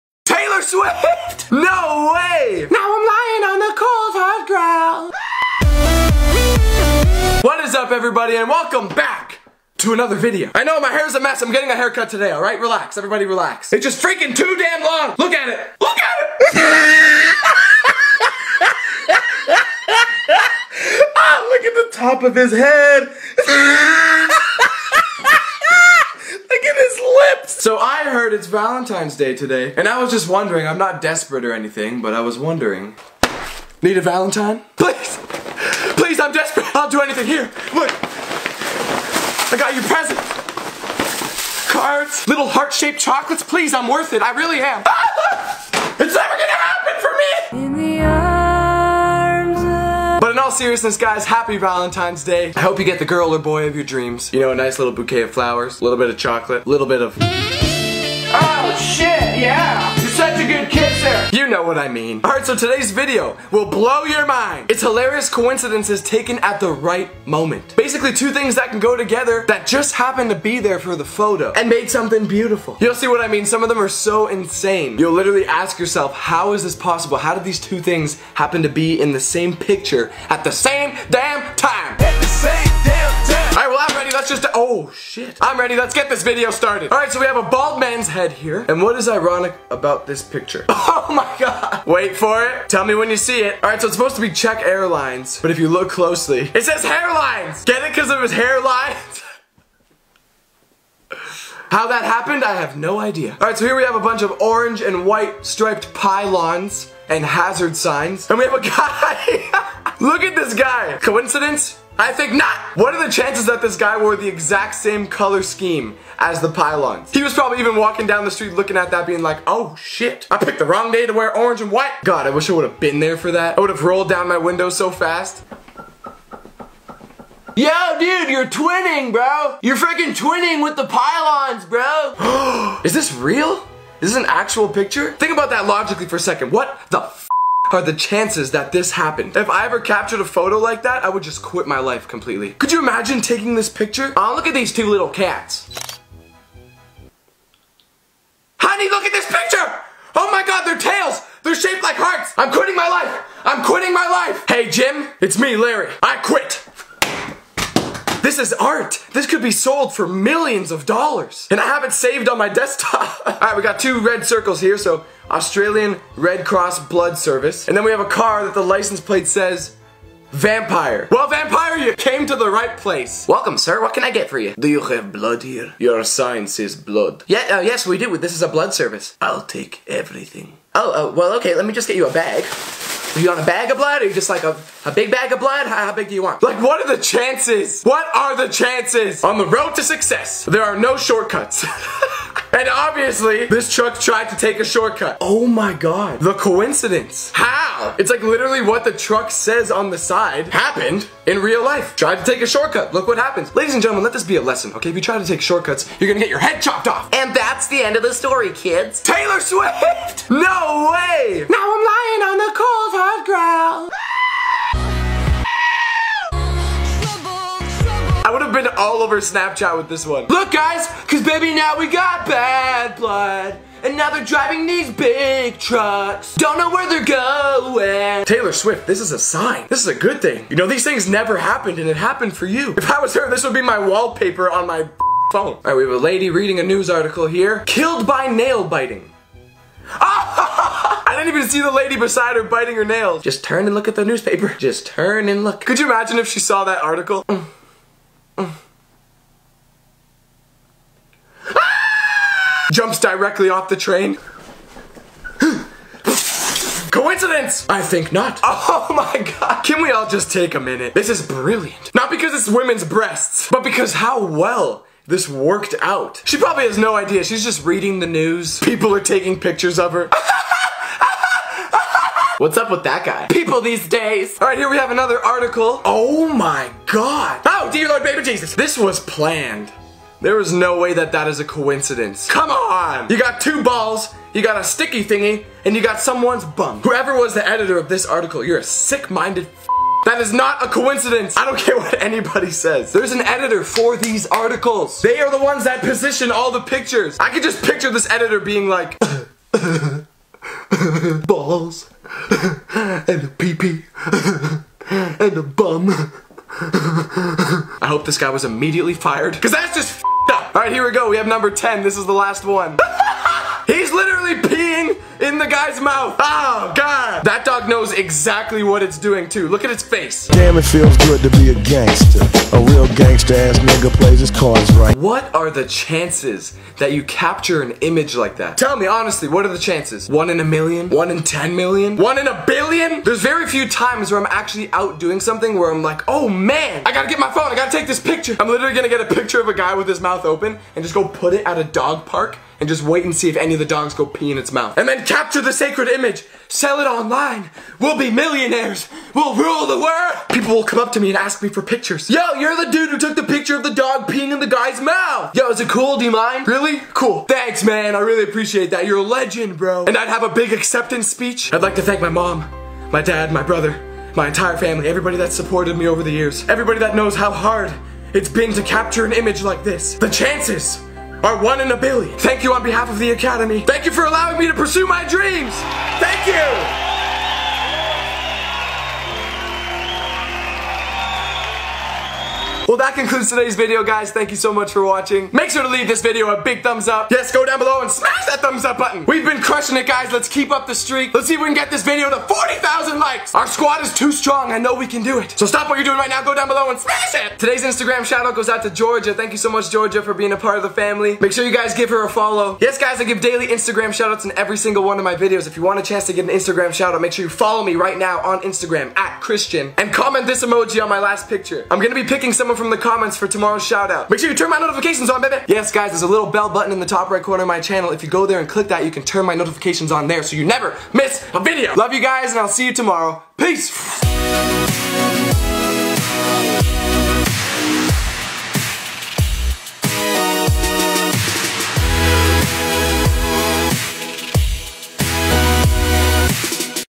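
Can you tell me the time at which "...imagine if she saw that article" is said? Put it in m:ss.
4:05.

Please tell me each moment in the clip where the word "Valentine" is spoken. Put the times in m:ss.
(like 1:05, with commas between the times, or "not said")
0:28, 0:34, 0:51.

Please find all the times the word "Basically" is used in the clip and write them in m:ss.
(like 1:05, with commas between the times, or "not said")
1:07.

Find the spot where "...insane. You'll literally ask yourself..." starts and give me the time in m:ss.
1:14.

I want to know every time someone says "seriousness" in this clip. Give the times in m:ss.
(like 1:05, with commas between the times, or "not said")
0:50.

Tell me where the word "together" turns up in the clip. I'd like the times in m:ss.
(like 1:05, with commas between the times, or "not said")
1:08.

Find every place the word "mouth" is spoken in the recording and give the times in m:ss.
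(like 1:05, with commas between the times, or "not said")
5:15, 5:40, 5:44, 5:54.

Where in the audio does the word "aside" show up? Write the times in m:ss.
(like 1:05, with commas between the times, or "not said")
not said.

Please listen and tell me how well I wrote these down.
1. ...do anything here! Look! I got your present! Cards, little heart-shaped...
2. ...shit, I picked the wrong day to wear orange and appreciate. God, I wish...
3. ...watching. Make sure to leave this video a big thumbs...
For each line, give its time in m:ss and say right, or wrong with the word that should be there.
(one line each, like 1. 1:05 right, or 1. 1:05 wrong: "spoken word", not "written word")
1. 0:36 right
2. 1:59 wrong: "white", not "appreciate"
3. 6:24 right.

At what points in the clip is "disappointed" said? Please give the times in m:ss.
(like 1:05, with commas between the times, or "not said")
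not said.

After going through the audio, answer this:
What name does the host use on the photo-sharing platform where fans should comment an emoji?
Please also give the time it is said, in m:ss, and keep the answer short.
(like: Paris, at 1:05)
Christian, at 6:48.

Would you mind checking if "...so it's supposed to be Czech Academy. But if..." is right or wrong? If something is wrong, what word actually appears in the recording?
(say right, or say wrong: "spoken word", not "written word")
wrong: "Airlines", not "Academy".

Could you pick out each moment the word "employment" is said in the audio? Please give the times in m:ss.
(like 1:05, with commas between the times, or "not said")
not said.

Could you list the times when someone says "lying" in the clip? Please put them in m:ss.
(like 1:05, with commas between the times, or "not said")
0:03, 3:31.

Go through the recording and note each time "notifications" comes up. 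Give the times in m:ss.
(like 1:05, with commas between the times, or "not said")
6:54, 6:59.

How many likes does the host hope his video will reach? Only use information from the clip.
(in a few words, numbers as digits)
40,000.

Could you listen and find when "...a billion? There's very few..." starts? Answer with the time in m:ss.
5:32.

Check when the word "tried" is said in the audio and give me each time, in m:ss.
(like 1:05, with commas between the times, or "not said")
3:13, 3:21.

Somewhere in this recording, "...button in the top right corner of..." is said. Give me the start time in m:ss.
6:56.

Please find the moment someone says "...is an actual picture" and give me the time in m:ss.
2:14.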